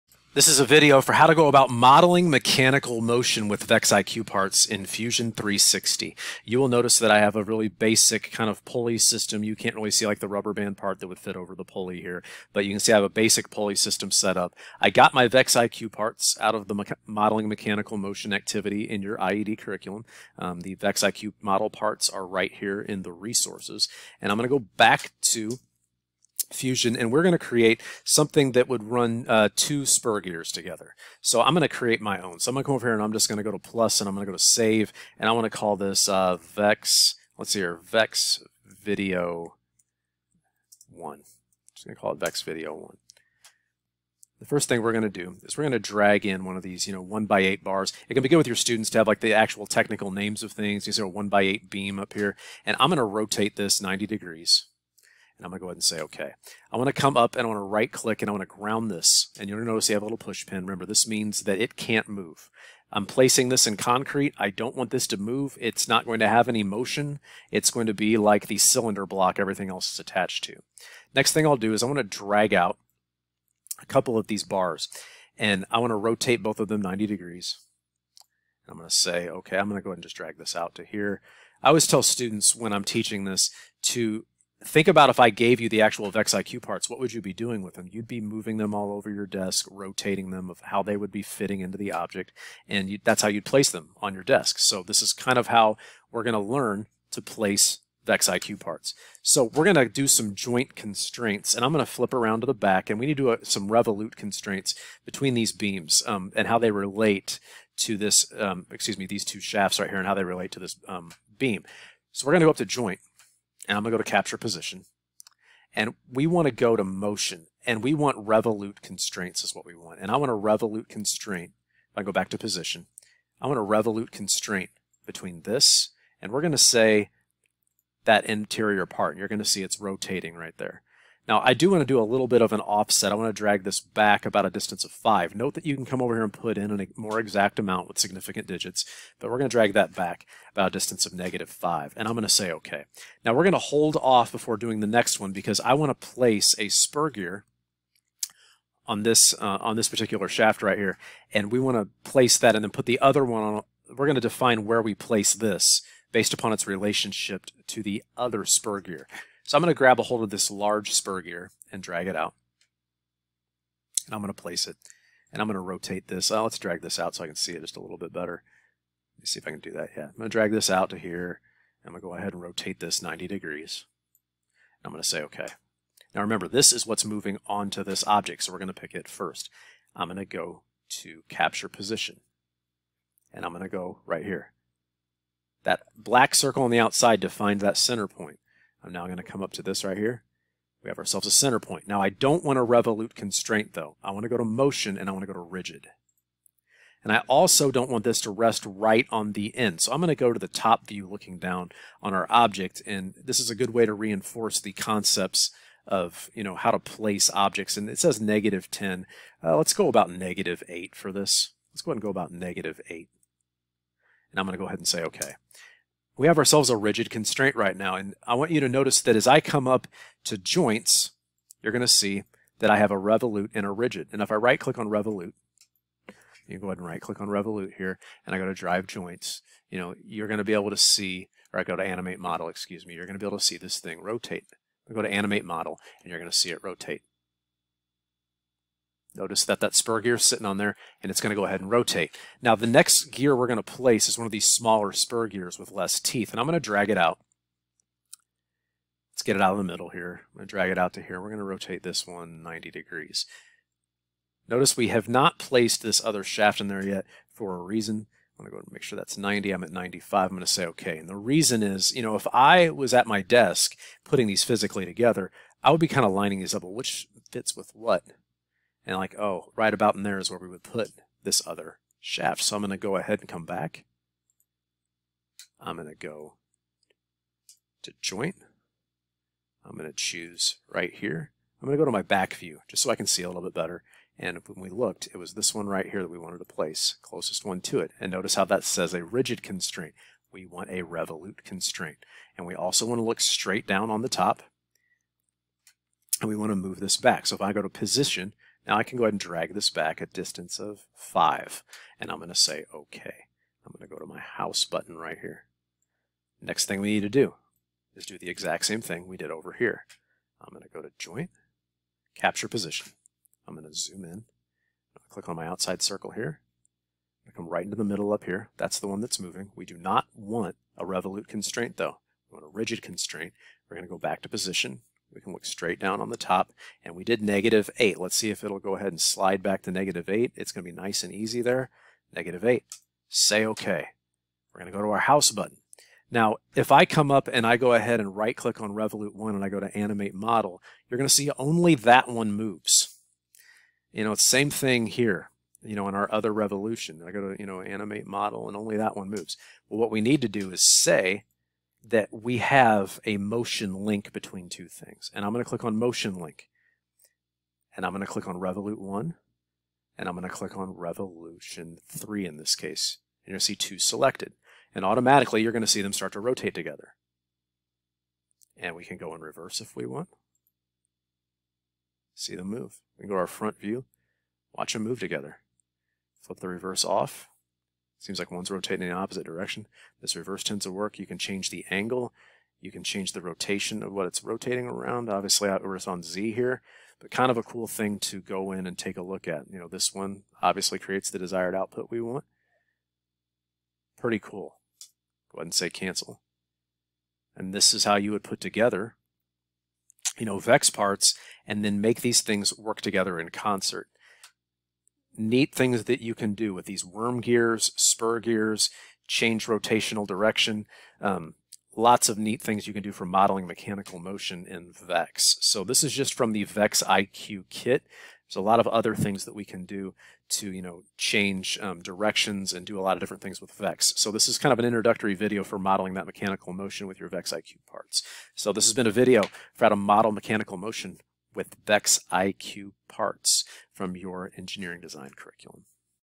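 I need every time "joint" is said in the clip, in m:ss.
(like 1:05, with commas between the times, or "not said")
1:40, 1:52, 3:40, 3:48, 4:38, 5:10.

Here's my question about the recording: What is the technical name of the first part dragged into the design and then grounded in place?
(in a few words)
one by eight beam.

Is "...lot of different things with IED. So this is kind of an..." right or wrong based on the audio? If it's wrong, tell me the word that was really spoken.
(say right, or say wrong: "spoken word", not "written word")
wrong: "VEX", not "IED".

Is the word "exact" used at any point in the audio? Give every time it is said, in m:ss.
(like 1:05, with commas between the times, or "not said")
2:17, 5:08.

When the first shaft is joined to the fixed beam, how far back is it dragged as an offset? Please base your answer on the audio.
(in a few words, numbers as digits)
-5.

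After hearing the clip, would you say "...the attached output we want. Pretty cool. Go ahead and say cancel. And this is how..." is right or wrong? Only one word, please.
wrong.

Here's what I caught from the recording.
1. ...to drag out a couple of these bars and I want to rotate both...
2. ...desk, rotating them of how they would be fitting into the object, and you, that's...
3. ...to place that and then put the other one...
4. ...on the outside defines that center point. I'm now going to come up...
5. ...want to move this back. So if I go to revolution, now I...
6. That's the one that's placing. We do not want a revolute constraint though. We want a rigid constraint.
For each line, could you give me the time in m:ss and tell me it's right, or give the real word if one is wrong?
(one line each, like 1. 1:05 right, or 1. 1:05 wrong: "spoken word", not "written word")
1. 1:11 right
2. 1:29 right
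3. 2:31 right
4. 3:06 right
5. 4:56 wrong: "position", not "revolution"
6. 5:18 wrong: "moving", not "placing".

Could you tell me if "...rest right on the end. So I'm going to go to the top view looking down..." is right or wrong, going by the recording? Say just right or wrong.
right.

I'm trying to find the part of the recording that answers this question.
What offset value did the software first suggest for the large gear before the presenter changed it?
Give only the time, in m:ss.
3:28.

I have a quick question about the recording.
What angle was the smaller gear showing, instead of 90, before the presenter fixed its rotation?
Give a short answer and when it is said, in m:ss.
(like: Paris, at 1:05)
95, at 4:19.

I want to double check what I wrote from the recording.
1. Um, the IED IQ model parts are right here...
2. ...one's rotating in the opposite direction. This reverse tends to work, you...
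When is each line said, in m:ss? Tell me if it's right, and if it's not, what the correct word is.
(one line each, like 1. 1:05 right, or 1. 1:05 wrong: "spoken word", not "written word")
1. 0:20 wrong: "VEX", not "IED"
2. 6:18 right.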